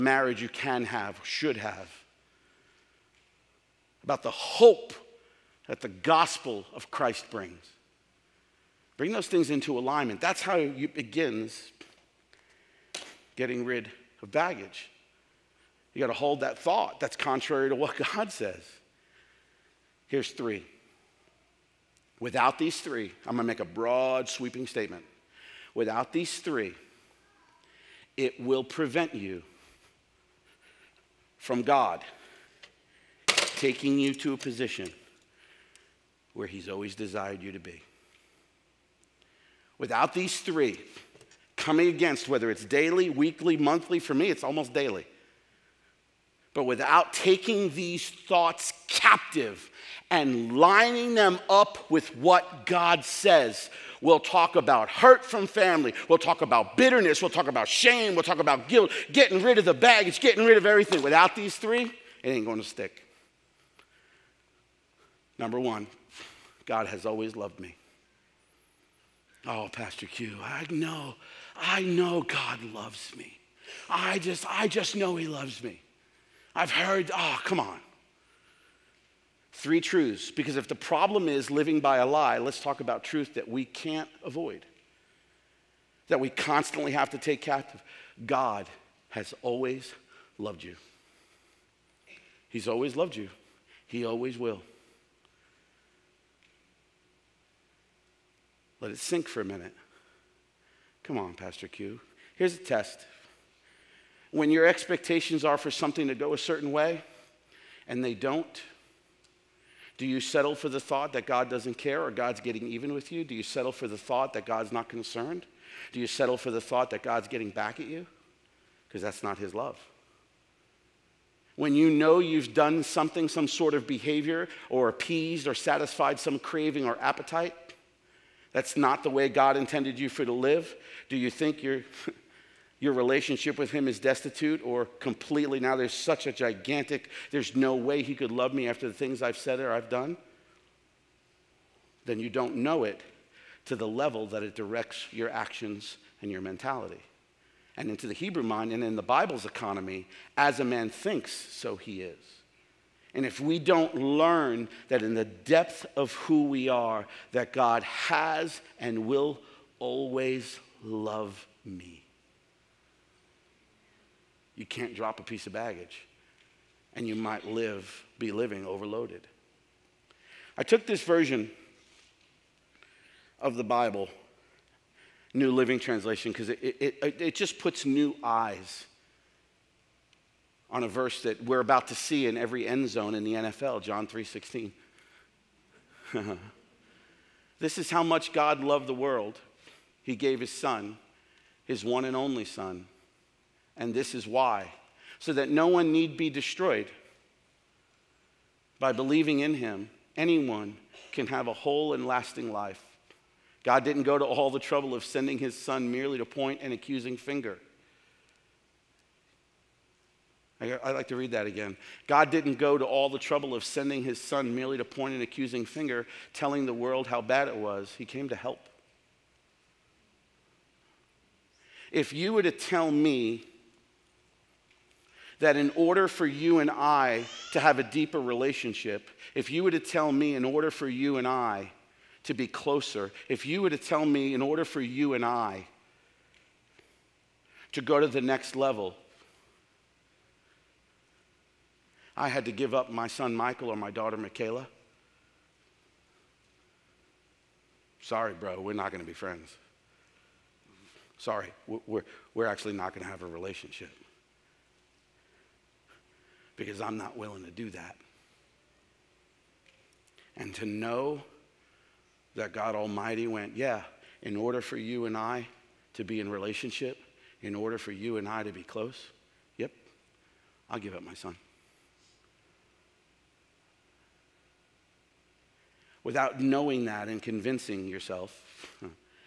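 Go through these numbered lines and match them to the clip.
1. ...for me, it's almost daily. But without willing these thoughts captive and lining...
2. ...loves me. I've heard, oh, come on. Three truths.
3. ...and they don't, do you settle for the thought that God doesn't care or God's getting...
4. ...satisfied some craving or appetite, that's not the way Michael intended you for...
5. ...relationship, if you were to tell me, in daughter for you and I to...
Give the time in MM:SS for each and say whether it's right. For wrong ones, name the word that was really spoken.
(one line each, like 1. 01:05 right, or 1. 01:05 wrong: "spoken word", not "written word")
1. 00:43 wrong: "taking", not "willing"
2. 01:15 right
3. 01:47 right
4. 02:05 wrong: "God", not "Michael"
5. 03:48 wrong: "order", not "daughter".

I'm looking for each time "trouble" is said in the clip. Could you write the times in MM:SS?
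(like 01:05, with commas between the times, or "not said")
03:24, 03:33.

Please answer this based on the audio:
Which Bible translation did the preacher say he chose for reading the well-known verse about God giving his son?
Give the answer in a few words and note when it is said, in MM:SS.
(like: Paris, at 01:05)
New Living Translation, at 02:55.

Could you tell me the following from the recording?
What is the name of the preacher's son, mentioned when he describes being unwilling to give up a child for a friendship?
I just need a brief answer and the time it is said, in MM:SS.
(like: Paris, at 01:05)
Michael, at 04:03.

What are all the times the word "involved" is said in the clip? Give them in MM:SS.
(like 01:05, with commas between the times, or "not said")
not said.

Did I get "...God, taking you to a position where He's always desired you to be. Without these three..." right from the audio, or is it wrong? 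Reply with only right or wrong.
right.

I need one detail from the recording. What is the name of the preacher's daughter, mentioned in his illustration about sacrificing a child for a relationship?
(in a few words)
Michaela.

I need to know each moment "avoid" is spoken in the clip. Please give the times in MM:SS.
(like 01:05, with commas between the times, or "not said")
01:24.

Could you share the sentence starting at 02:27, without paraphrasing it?
And into the Hebrew mind and in the Bible's economy, as a man thinks, so he is.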